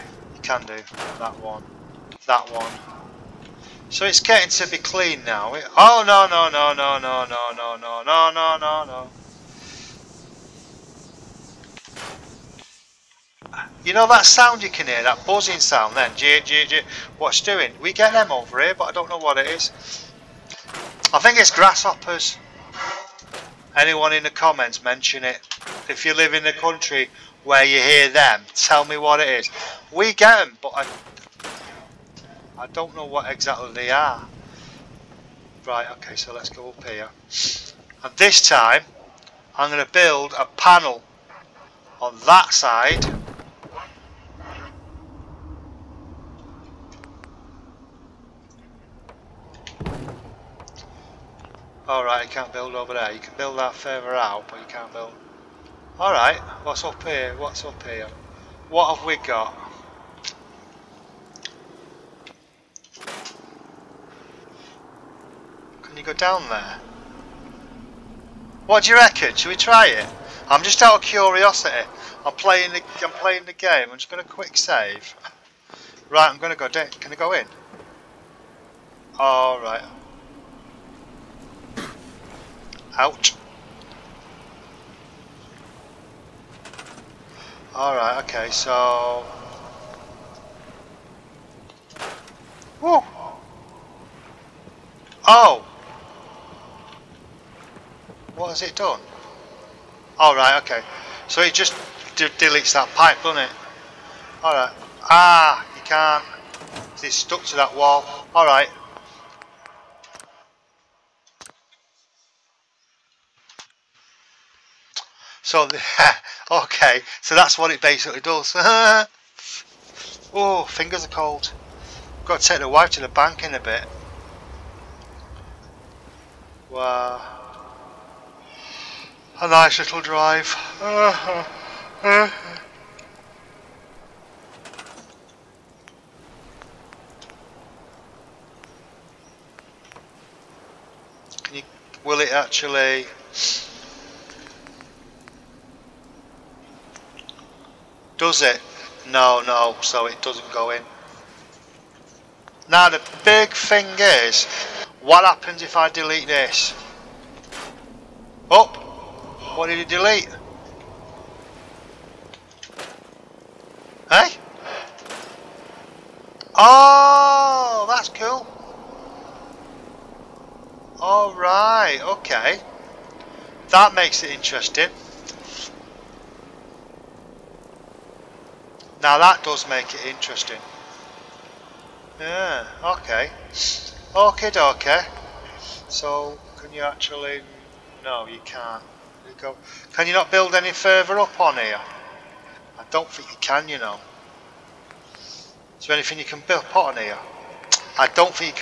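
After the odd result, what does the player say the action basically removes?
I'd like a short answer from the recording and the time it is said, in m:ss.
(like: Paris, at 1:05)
That pipe, at 1:42.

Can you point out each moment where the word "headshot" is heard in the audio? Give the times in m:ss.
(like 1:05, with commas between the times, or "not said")
not said.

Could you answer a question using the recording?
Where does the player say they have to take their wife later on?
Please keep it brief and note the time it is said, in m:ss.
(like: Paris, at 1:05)
The bank, at 2:03.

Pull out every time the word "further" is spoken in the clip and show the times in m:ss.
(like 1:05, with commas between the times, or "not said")
0:53, 3:10.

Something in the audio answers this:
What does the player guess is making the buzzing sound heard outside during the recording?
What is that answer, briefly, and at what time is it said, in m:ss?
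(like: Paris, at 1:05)
Grasshoppers, at 0:21.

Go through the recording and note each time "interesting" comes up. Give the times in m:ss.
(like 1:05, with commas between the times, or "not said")
2:54, 3:00.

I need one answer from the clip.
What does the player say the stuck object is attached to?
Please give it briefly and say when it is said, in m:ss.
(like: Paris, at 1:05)
That wall, at 1:47.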